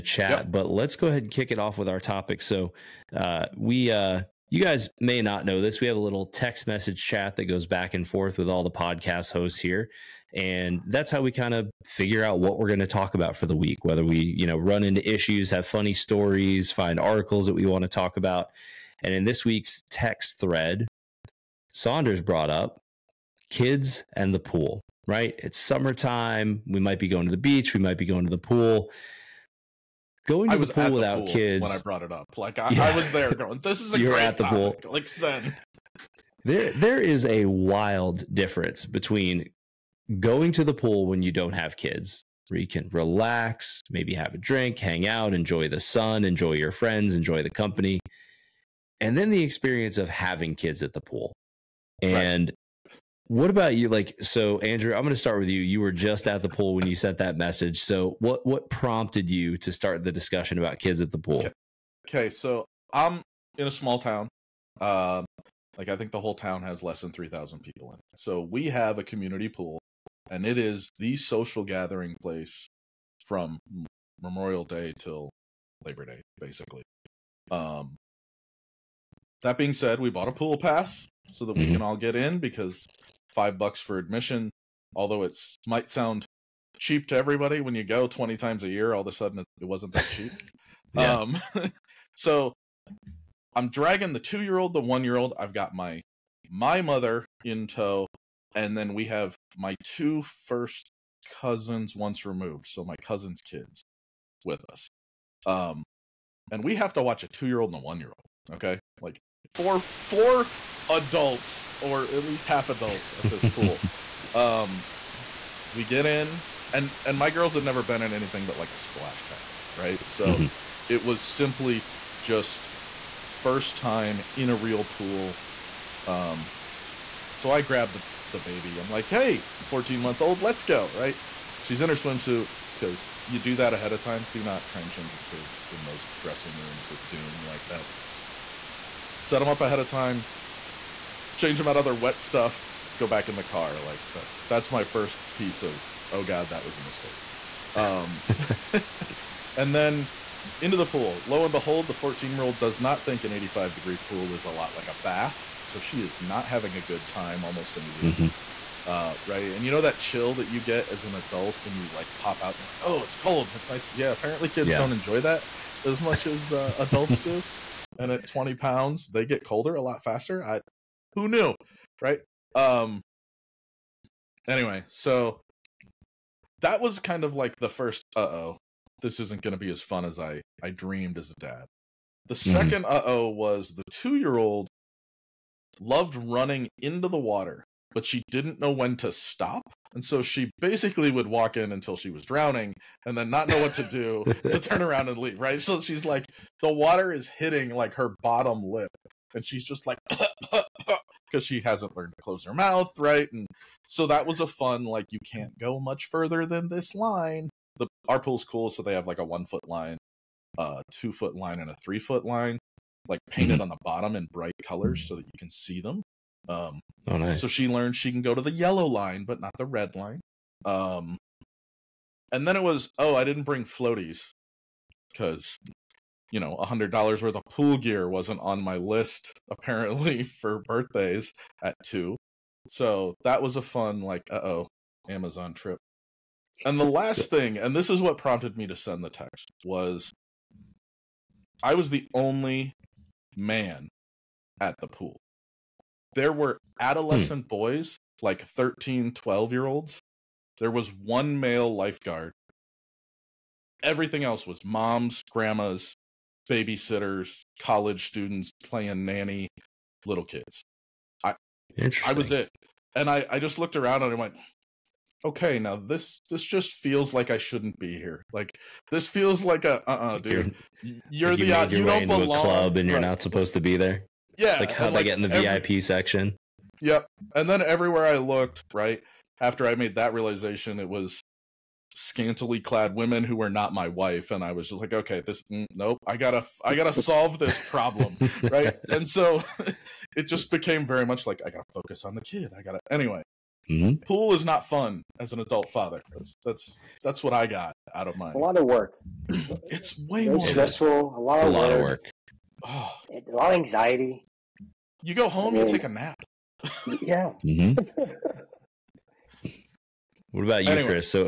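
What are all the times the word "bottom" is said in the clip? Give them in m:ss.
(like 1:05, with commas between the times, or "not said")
3:18, 3:33.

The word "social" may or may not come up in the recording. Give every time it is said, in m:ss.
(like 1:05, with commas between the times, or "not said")
1:11.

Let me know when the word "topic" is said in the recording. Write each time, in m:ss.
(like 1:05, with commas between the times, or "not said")
0:02, 0:34.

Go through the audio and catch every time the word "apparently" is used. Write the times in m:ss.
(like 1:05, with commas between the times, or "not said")
2:44, 3:49.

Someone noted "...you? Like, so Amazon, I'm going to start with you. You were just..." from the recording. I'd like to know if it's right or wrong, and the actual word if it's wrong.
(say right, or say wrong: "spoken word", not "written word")
wrong: "Andrew", not "Amazon".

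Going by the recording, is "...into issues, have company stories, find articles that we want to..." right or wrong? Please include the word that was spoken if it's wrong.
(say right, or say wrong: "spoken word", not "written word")
wrong: "funny", not "company".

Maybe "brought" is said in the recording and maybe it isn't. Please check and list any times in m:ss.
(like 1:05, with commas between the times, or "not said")
0:22, 0:31.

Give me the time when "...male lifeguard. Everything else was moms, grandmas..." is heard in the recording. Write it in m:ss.
4:11.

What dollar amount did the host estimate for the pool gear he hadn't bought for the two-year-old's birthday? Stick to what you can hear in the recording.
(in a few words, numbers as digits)
100 dollars.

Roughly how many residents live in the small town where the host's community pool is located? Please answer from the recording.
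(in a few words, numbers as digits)
fewer than 3,000.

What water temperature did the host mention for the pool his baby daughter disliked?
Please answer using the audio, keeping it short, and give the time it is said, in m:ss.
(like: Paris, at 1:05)
85 degrees, at 2:33.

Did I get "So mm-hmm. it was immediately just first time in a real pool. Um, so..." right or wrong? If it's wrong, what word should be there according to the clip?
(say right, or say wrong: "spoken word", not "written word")
wrong: "simply", not "immediately".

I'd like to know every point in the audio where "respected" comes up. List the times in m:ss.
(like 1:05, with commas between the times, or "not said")
not said.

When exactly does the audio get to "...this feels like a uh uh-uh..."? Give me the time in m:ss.
4:28.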